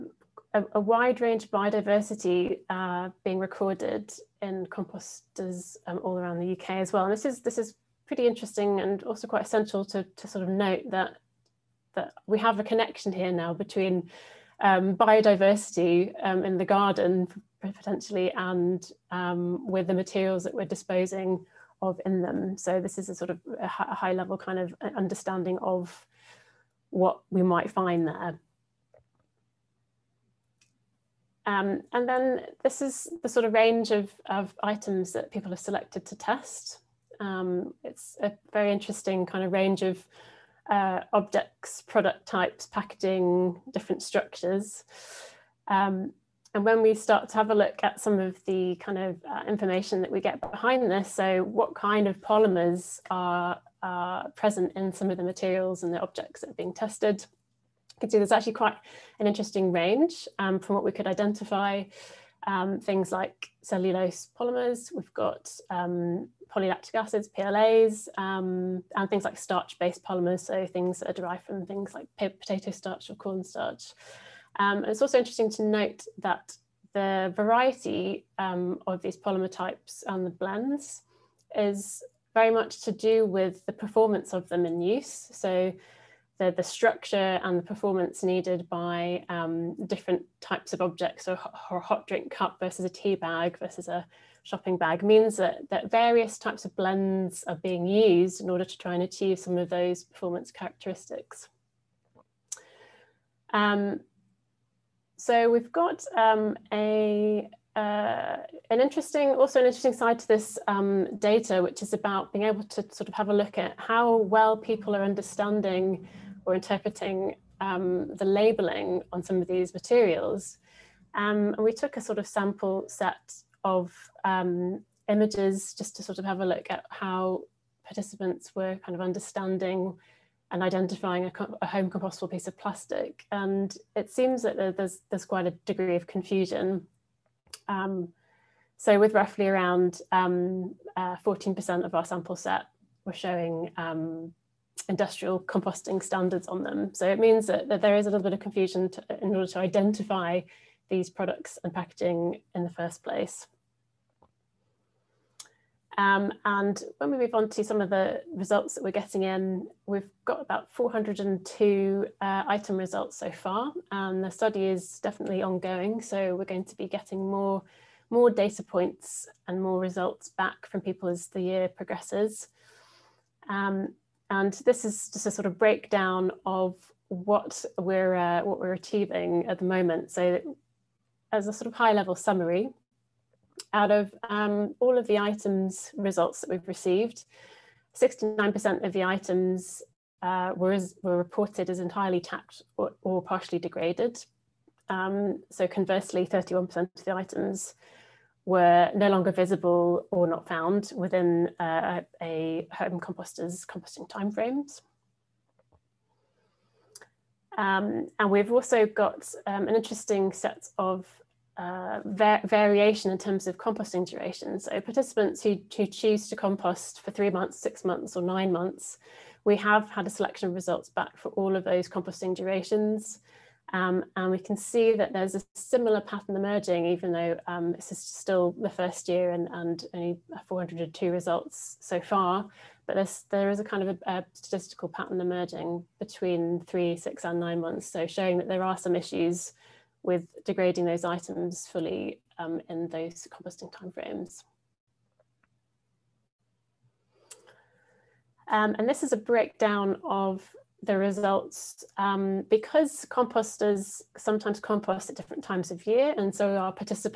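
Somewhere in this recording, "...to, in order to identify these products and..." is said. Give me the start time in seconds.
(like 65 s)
148 s.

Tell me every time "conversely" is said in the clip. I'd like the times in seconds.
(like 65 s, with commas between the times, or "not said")
195 s.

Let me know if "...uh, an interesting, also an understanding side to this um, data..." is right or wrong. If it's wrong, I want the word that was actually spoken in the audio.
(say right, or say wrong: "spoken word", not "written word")
wrong: "interesting", not "understanding".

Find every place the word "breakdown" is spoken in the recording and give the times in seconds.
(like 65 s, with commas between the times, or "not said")
175 s, 249 s.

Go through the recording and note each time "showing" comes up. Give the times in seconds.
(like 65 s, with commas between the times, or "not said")
143 s, 238 s.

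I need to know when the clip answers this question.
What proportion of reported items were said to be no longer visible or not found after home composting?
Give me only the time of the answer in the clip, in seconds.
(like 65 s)
196 s.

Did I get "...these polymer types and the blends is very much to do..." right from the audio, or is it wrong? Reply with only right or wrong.
right.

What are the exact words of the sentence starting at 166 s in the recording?
So we're going to be getting more, more data points and more results back from people as the year progresses.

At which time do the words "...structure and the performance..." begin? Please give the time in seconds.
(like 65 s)
86 s.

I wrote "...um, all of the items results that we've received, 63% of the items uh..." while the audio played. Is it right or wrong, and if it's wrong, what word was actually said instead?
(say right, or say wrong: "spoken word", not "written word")
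wrong: "69", not "63".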